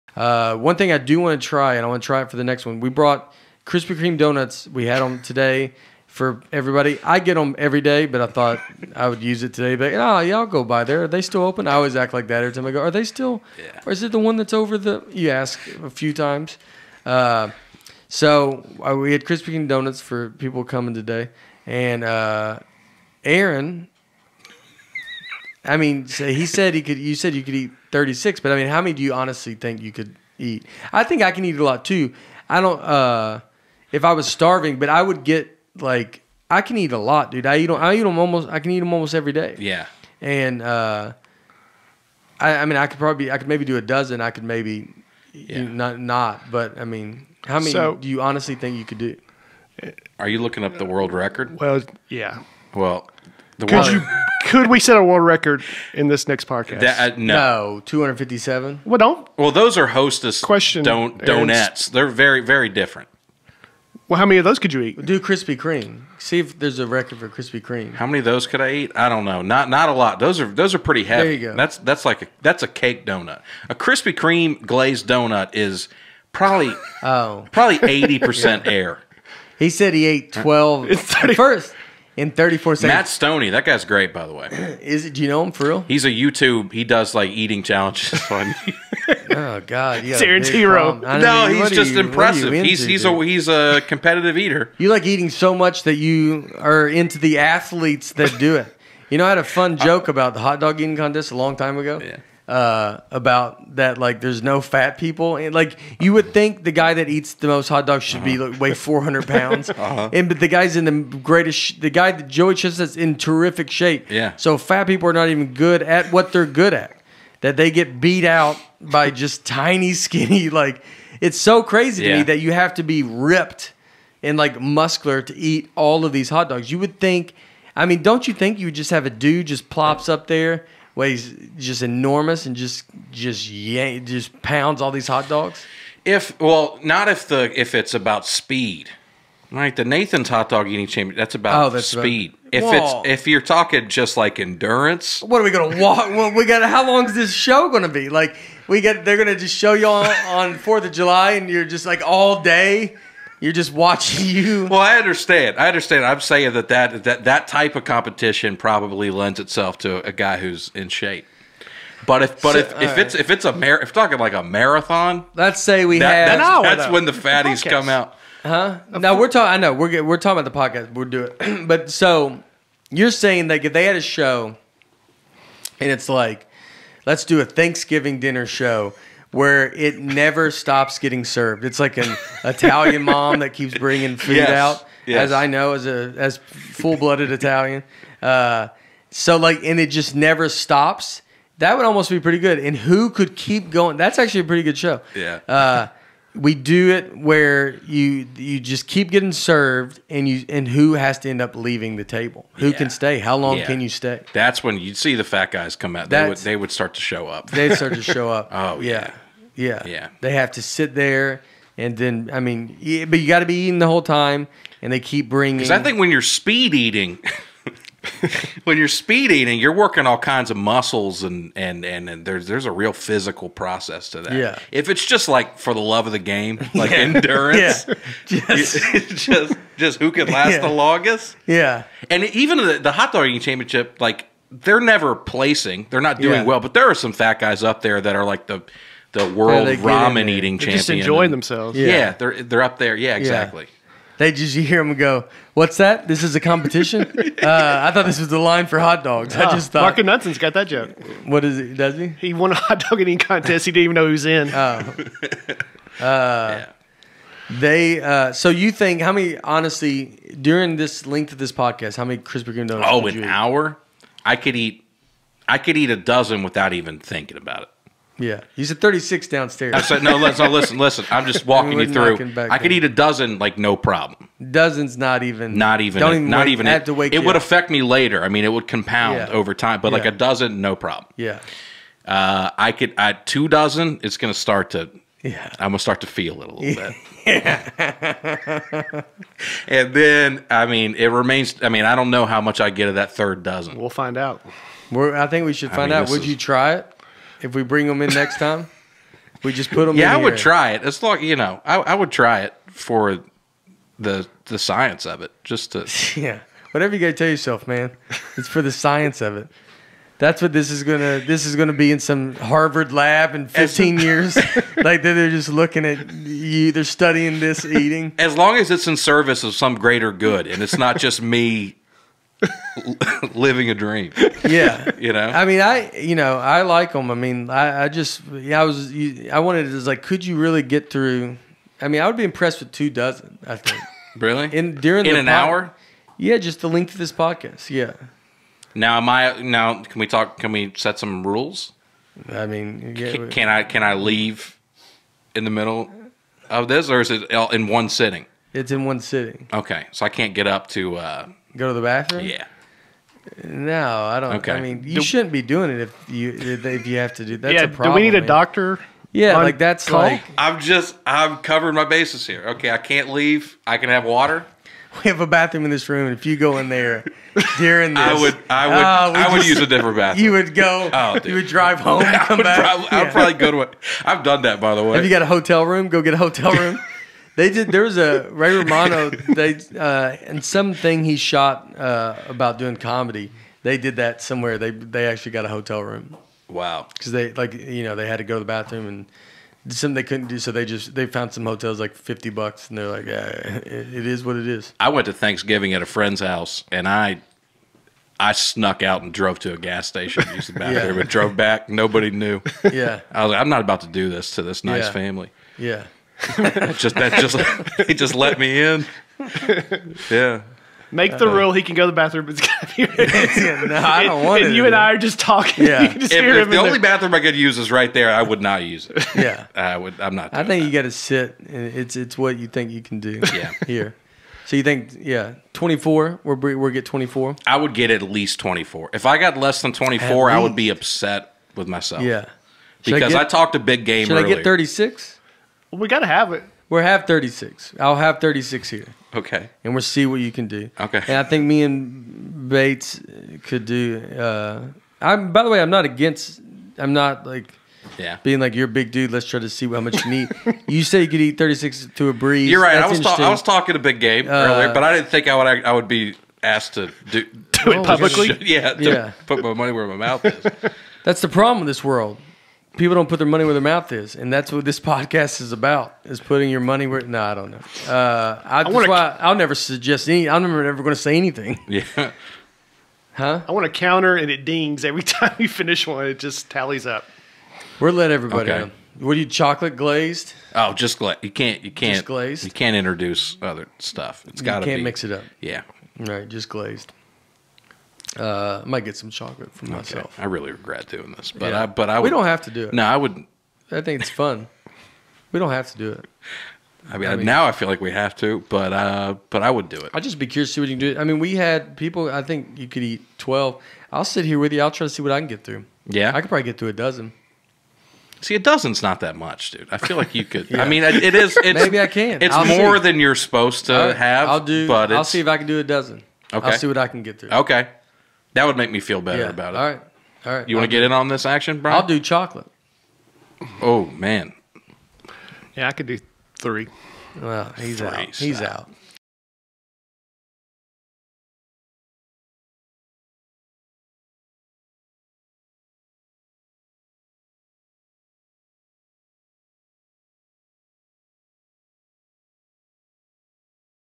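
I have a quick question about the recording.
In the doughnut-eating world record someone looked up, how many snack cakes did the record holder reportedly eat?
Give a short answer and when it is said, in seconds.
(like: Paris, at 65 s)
257, at 57 s.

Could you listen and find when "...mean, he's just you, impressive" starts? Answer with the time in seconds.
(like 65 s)
91 s.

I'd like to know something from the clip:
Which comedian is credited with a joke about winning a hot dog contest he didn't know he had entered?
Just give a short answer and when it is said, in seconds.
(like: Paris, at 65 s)
Mark Nunson, at 249 s.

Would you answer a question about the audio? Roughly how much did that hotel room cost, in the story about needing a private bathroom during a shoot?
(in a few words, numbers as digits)
$50.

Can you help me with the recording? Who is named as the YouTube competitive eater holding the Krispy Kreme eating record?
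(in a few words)
Matt Stoney.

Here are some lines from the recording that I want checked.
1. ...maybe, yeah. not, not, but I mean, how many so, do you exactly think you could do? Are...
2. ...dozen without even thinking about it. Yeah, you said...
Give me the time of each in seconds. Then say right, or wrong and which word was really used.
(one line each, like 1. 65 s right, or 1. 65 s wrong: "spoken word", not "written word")
1. 44 s wrong: "honestly", not "exactly"
2. 265 s right.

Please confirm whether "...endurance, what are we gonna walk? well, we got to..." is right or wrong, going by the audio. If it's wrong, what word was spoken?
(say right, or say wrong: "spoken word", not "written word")
right.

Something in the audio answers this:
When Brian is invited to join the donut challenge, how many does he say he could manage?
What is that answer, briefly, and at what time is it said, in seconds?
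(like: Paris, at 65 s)
3, at 526 s.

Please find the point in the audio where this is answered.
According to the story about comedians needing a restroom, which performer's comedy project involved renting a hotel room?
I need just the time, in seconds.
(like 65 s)
378 s.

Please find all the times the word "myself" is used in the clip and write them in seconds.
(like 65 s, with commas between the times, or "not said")
431 s, 489 s.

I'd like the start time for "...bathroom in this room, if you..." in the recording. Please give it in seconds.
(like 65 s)
365 s.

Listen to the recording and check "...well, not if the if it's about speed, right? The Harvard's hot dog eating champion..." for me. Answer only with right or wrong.
wrong.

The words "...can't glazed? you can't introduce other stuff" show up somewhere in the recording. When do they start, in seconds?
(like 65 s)
481 s.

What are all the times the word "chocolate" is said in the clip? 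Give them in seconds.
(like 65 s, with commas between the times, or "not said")
479 s, 489 s, 521 s.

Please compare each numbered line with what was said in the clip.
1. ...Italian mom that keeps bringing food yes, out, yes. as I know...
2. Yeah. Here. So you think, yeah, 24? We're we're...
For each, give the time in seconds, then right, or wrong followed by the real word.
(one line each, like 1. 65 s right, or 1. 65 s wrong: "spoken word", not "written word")
1. 182 s right
2. 423 s right.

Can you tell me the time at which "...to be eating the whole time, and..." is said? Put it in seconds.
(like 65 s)
213 s.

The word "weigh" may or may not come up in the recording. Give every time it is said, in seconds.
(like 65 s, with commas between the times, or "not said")
108 s, 130 s.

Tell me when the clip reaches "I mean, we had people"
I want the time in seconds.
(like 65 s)
500 s.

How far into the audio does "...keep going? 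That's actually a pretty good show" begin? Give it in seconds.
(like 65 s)
193 s.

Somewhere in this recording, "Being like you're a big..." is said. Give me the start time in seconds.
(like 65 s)
448 s.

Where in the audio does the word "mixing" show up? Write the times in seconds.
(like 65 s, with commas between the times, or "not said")
not said.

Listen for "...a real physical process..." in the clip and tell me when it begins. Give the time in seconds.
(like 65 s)
222 s.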